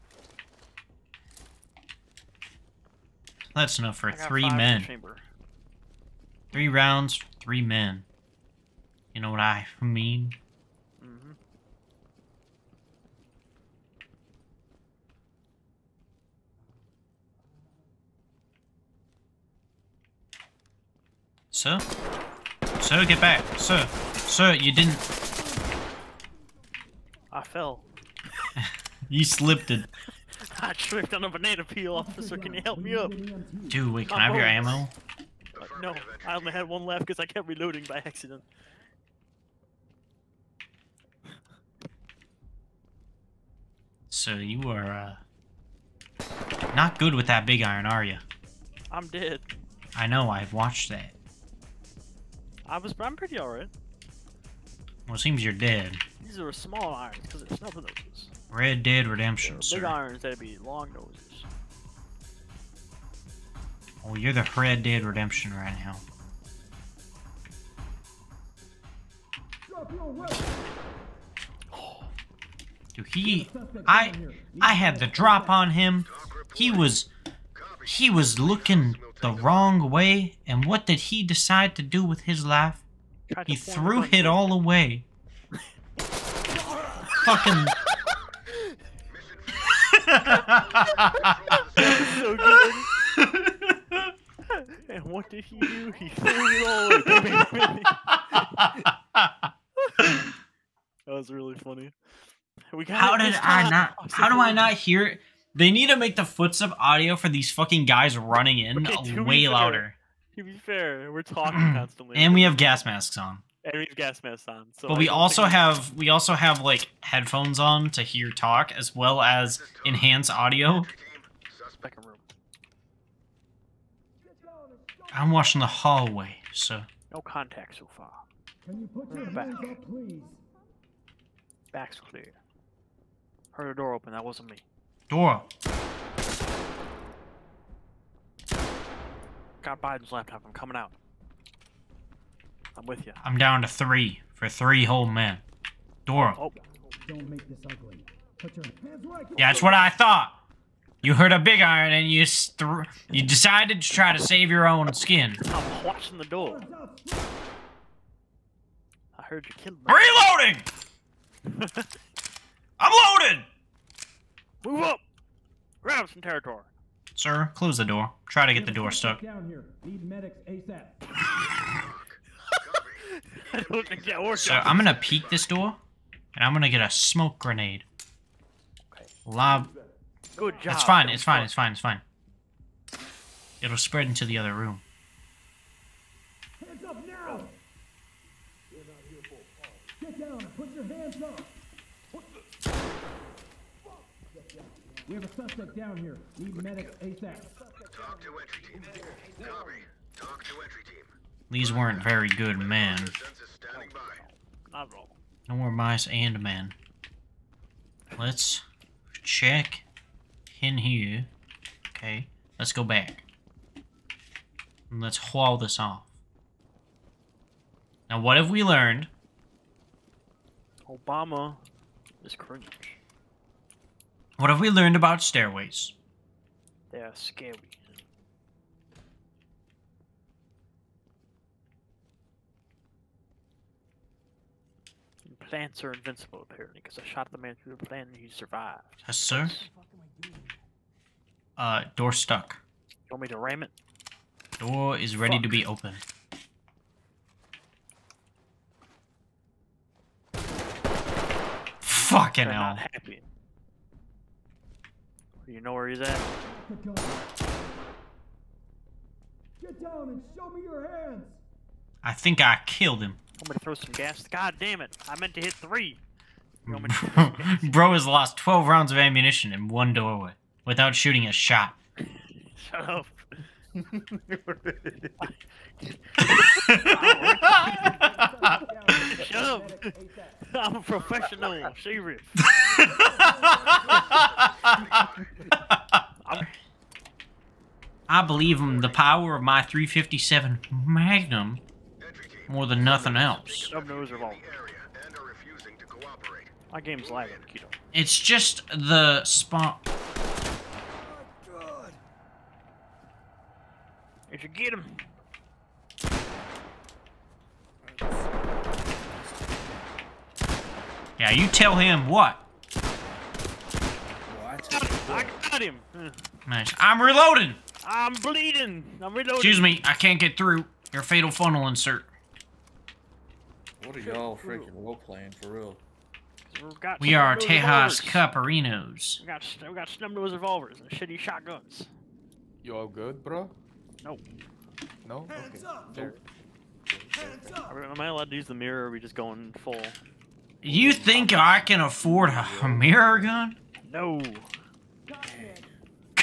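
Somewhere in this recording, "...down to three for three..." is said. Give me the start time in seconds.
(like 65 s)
143 s.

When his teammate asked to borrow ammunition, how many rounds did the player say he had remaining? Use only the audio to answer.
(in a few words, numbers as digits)
1.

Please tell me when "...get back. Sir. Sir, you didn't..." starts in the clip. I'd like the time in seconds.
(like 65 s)
23 s.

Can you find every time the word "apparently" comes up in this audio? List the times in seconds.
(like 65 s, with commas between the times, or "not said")
236 s.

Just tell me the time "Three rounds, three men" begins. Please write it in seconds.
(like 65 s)
6 s.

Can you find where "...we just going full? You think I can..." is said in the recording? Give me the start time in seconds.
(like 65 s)
338 s.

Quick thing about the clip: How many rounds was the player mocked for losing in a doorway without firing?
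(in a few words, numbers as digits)
12.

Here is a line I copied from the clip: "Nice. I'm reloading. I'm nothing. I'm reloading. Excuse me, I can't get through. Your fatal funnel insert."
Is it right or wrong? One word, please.
wrong.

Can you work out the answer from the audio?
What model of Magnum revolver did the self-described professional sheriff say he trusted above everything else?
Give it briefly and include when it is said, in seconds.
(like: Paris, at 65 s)
357, at 289 s.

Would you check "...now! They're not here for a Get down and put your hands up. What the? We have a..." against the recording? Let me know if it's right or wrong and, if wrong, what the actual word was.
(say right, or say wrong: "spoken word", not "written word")
right.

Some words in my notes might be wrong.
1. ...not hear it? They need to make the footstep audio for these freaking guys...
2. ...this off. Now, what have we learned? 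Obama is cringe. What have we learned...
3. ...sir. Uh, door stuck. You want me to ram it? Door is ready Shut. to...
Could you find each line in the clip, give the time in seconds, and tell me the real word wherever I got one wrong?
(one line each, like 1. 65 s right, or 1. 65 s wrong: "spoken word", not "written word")
1. 104 s wrong: "fucking", not "freaking"
2. 215 s right
3. 239 s wrong: "Fuck", not "Shut".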